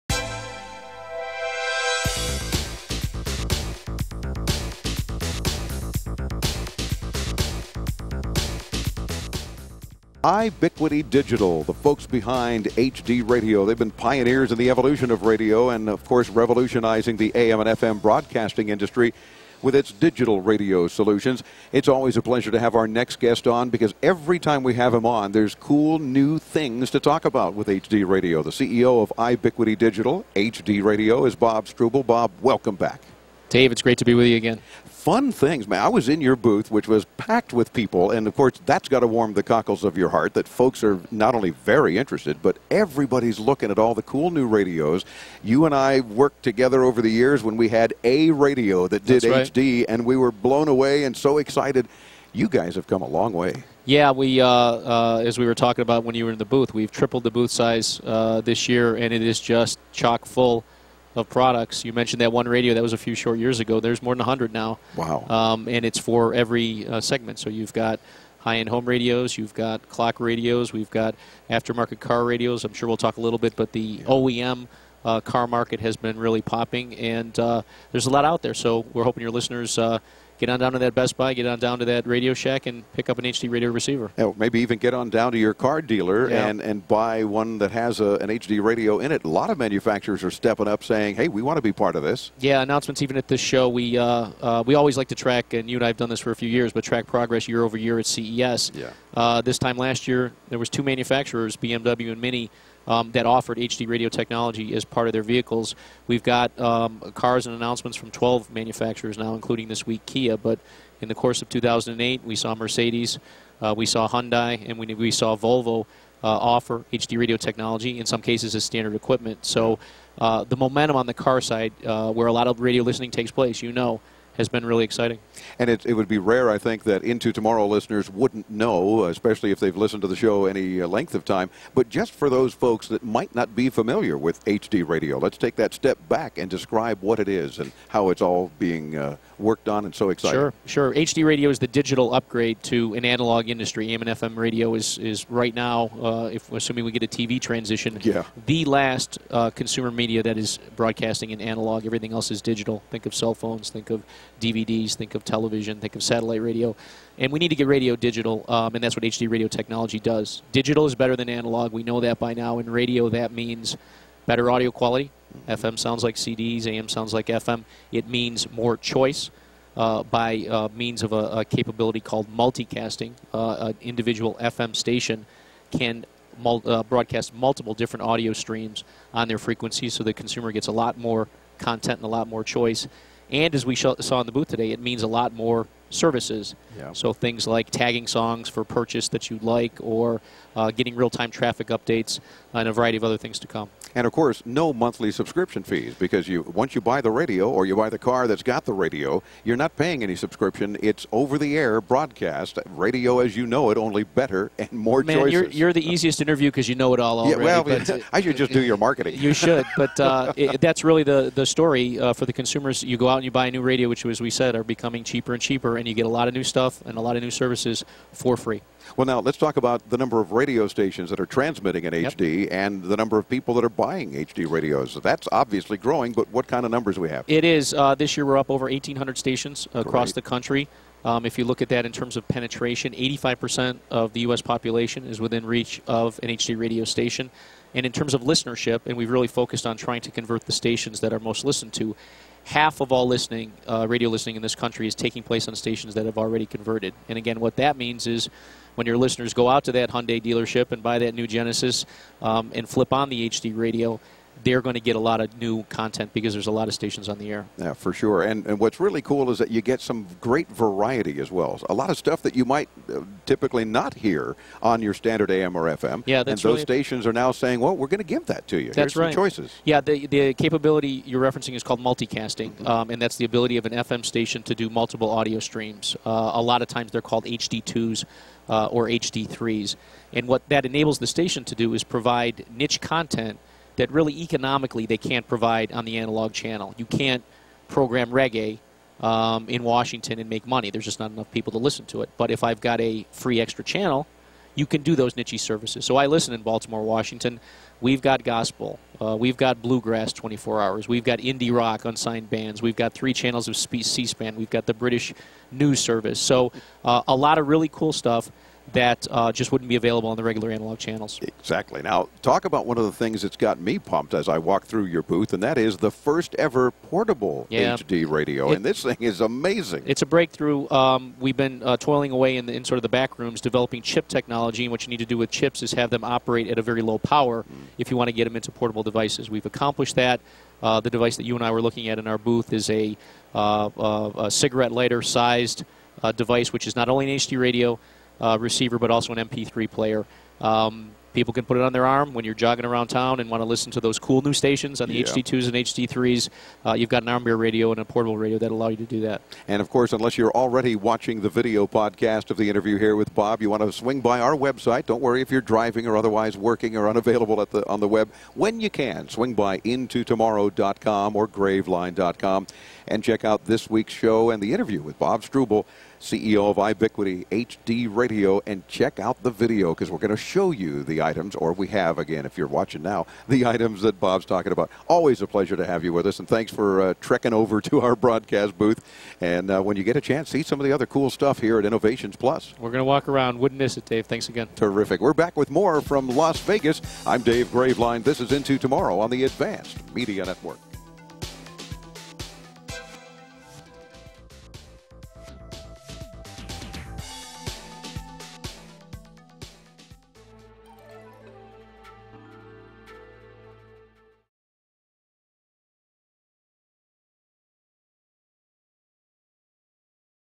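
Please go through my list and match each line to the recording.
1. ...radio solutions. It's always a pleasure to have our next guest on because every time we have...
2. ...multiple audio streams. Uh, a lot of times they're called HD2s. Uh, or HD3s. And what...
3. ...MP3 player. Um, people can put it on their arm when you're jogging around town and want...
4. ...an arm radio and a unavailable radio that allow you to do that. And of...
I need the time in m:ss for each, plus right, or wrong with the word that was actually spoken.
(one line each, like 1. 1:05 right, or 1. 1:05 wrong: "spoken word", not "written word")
1. 0:20 right
2. 4:34 right
3. 5:39 right
4. 5:47 wrong: "portable", not "unavailable".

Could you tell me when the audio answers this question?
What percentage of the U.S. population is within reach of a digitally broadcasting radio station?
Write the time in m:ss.
3:52.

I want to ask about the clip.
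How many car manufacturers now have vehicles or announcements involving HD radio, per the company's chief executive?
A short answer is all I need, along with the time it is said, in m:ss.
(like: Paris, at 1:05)
12, at 1:48.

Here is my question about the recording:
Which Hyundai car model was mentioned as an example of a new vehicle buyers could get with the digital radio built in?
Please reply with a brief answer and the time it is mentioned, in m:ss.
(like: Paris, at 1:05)
Genesis, at 4:11.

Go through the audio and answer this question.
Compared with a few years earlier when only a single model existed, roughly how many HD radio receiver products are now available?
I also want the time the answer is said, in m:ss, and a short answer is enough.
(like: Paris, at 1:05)
more than 100, at 1:04.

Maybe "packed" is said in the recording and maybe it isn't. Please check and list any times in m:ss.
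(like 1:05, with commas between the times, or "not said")
0:37.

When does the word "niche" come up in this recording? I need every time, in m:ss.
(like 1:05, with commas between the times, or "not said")
4:42, 4:55.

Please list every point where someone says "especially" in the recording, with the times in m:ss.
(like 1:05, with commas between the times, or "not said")
2:09.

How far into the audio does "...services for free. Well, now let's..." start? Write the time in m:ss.
3:37.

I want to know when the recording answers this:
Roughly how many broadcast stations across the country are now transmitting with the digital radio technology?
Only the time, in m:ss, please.
3:48.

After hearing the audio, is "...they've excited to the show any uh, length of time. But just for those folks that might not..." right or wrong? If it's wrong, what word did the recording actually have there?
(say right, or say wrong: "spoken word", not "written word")
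wrong: "listened", not "excited".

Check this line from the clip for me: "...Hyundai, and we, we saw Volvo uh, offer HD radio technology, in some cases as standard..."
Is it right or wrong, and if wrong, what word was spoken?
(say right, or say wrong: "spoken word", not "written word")
right.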